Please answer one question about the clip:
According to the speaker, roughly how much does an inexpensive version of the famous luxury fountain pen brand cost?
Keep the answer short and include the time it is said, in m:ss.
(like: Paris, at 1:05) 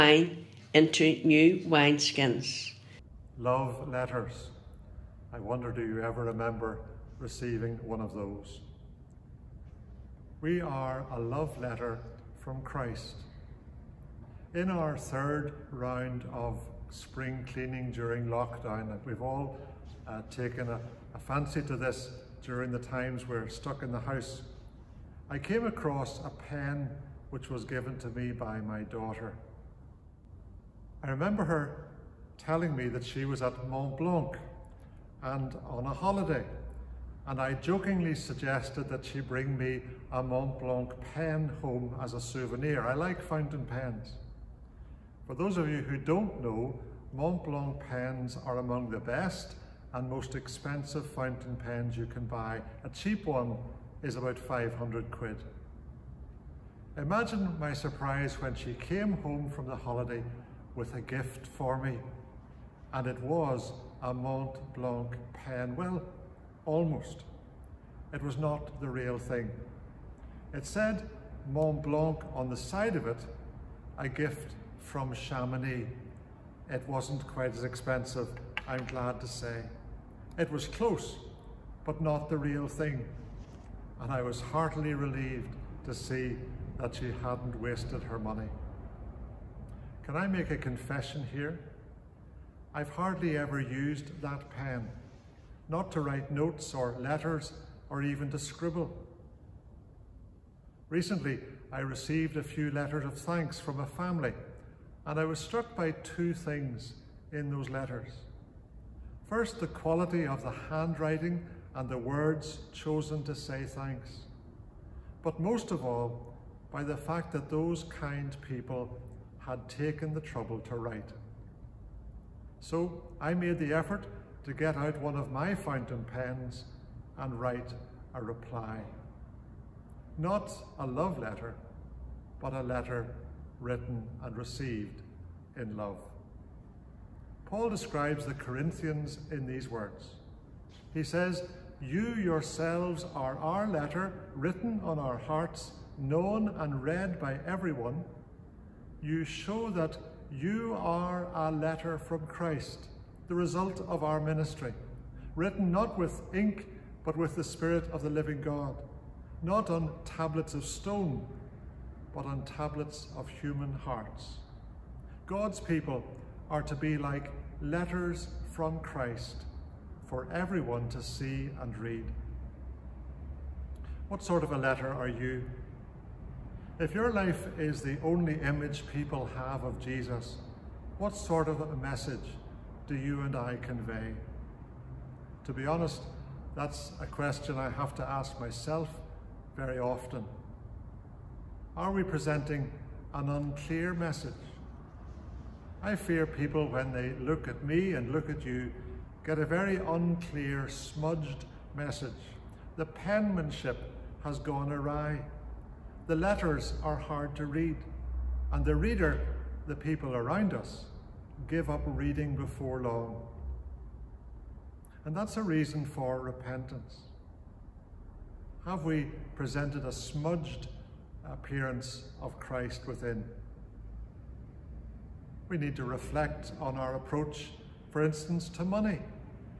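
500 quid, at 0:54.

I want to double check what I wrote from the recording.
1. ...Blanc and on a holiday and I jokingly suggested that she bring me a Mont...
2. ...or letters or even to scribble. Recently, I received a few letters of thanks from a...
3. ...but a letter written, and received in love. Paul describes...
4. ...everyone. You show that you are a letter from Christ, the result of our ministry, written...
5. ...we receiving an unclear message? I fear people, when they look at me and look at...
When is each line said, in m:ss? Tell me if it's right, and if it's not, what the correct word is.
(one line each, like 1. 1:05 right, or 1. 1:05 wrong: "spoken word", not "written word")
1. 0:33 right
2. 1:36 right
3. 2:12 right
4. 2:27 right
5. 3:11 wrong: "presenting", not "receiving".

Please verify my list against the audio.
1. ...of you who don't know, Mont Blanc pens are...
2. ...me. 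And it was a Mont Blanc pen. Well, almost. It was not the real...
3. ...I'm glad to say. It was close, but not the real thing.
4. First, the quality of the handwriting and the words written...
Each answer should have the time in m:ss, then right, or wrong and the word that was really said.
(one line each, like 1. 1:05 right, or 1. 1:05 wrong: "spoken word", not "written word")
1. 0:45 right
2. 1:01 right
3. 1:18 right
4. 1:49 wrong: "chosen", not "written".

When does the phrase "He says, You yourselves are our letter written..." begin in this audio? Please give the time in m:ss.
2:20.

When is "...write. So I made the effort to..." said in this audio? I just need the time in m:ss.
2:00.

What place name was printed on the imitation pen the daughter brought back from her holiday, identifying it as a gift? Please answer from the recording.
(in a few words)
Chamonix.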